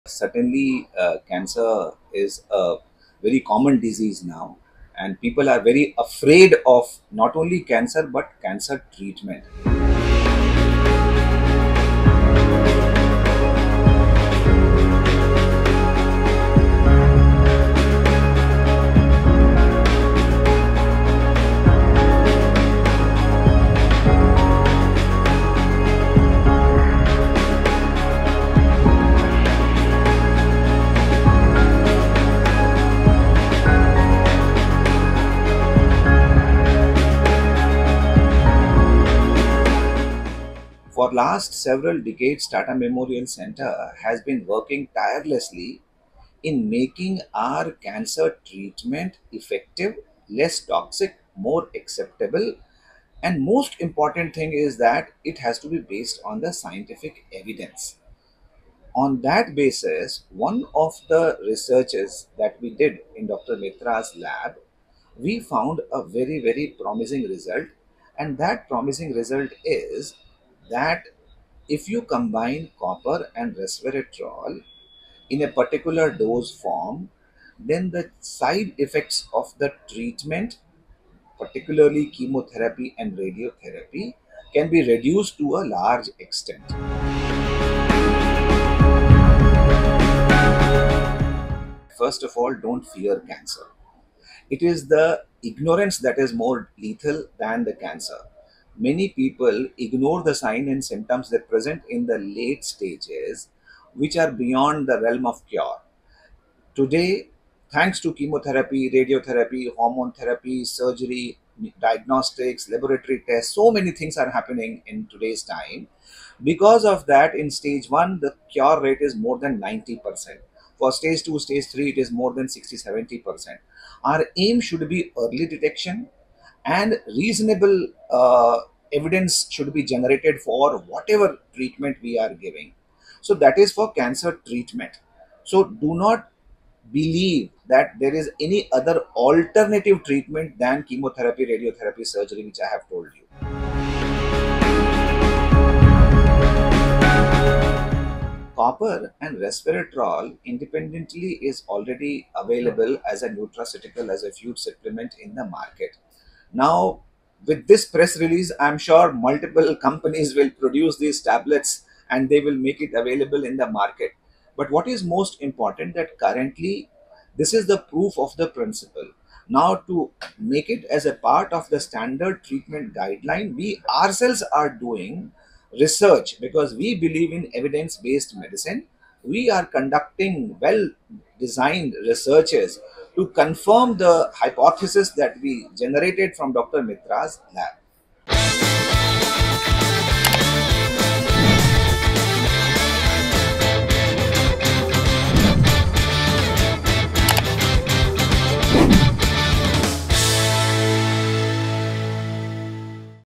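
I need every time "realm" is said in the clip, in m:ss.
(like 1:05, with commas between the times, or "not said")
1:45.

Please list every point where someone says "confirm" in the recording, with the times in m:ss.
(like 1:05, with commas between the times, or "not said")
3:03.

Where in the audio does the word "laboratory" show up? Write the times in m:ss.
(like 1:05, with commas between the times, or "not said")
1:52.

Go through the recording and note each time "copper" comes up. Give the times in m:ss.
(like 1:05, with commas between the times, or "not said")
1:12, 2:28.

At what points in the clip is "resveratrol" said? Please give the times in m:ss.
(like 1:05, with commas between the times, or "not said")
1:13, 2:29.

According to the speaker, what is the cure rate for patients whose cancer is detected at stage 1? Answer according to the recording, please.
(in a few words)
more than 90%.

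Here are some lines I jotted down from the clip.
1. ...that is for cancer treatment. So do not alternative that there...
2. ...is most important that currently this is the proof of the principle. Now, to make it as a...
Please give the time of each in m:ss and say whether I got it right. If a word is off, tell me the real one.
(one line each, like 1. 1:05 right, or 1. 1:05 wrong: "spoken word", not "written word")
1. 2:13 wrong: "believe", not "alternative"
2. 2:44 right.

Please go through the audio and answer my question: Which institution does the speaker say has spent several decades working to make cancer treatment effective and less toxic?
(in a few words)
Tata Memorial Center.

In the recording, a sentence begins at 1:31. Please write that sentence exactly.
First of all, don't fear cancer.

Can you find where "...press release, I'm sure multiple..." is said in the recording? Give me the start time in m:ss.
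2:37.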